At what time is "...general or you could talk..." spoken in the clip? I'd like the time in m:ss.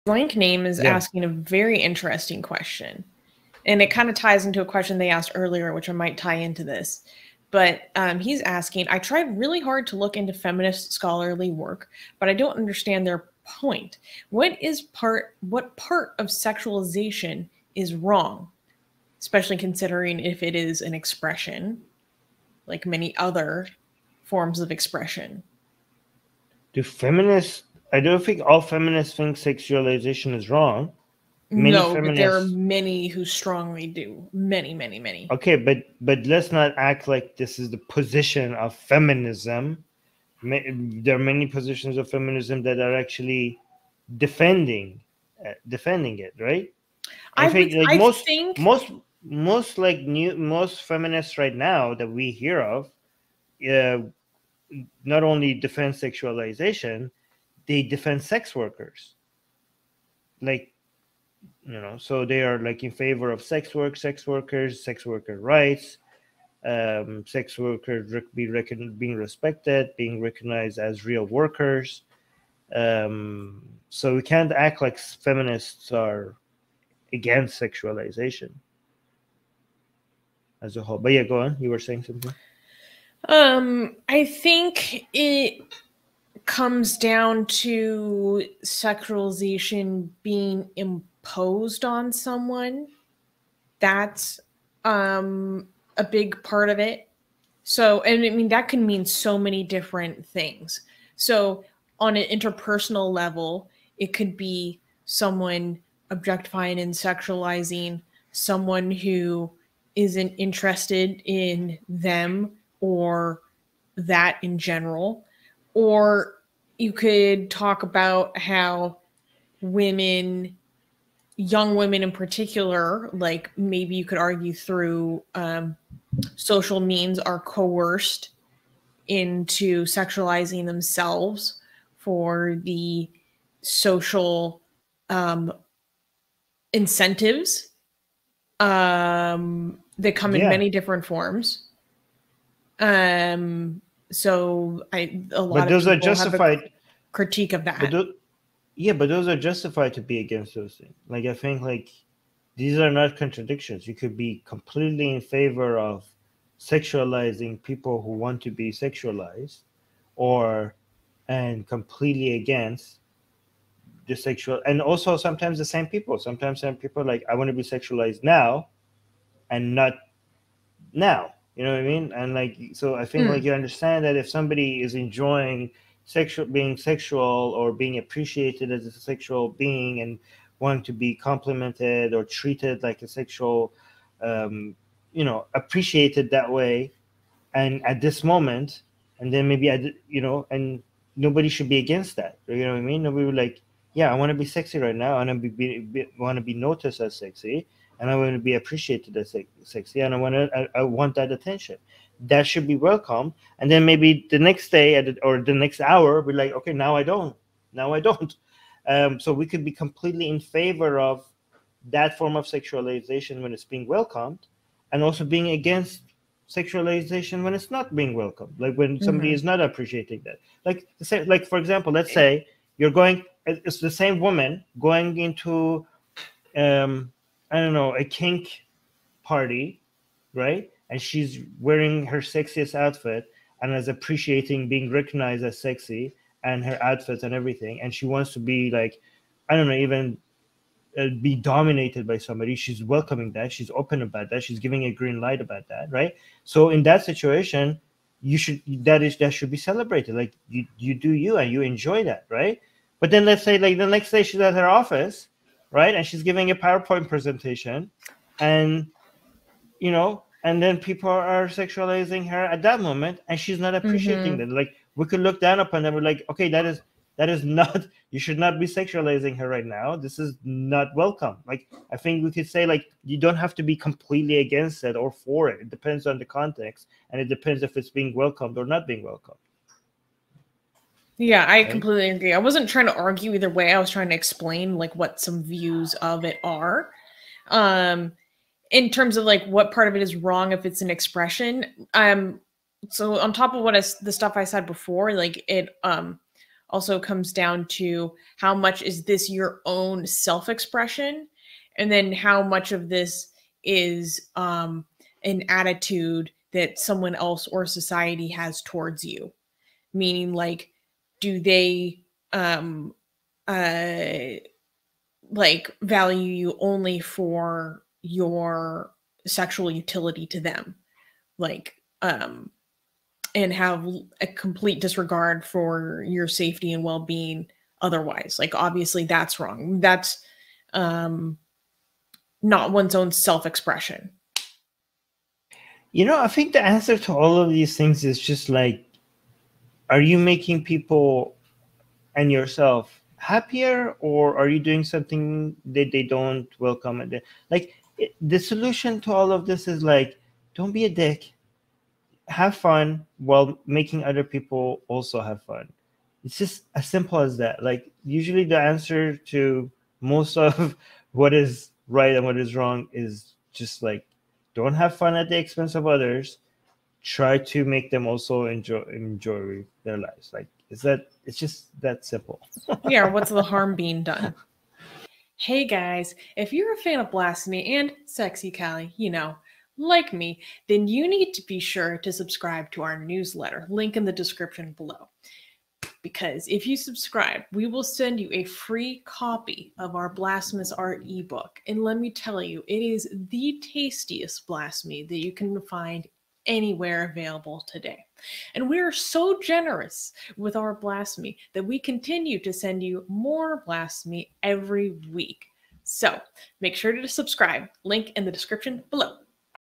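1:54.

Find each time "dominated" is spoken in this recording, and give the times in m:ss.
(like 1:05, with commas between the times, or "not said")
4:01.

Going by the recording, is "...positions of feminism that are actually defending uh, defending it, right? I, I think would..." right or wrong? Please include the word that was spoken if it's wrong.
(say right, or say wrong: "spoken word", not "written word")
right.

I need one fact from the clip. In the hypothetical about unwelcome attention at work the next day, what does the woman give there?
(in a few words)
PowerPoint presentation.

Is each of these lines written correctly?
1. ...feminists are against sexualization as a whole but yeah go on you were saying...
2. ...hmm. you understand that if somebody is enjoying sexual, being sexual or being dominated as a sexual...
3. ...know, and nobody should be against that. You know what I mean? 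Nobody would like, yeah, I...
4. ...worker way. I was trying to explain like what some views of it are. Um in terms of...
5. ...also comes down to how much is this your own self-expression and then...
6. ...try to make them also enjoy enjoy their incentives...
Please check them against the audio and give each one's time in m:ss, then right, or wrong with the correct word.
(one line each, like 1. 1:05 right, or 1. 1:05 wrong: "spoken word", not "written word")
1. 1:14 right
2. 2:53 wrong: "appreciated", not "dominated"
3. 3:10 right
4. 4:43 wrong: "either", not "worker"
5. 4:56 right
6. 6:07 wrong: "lives", not "incentives".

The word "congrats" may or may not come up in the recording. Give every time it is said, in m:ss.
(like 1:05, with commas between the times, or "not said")
not said.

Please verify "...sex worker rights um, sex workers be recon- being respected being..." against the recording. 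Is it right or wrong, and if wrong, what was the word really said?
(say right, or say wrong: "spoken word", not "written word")
right.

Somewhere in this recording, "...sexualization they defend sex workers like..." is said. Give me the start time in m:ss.
0:55.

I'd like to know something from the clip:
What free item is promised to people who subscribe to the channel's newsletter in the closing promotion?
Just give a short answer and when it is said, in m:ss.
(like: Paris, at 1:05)
Blasphemous Art ebook, at 6:30.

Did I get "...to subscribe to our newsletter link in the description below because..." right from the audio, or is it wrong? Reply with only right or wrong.
right.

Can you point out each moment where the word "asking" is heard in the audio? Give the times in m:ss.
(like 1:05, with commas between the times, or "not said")
0:00, 0:08.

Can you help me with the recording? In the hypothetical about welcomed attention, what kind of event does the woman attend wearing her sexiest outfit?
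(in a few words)
kink party.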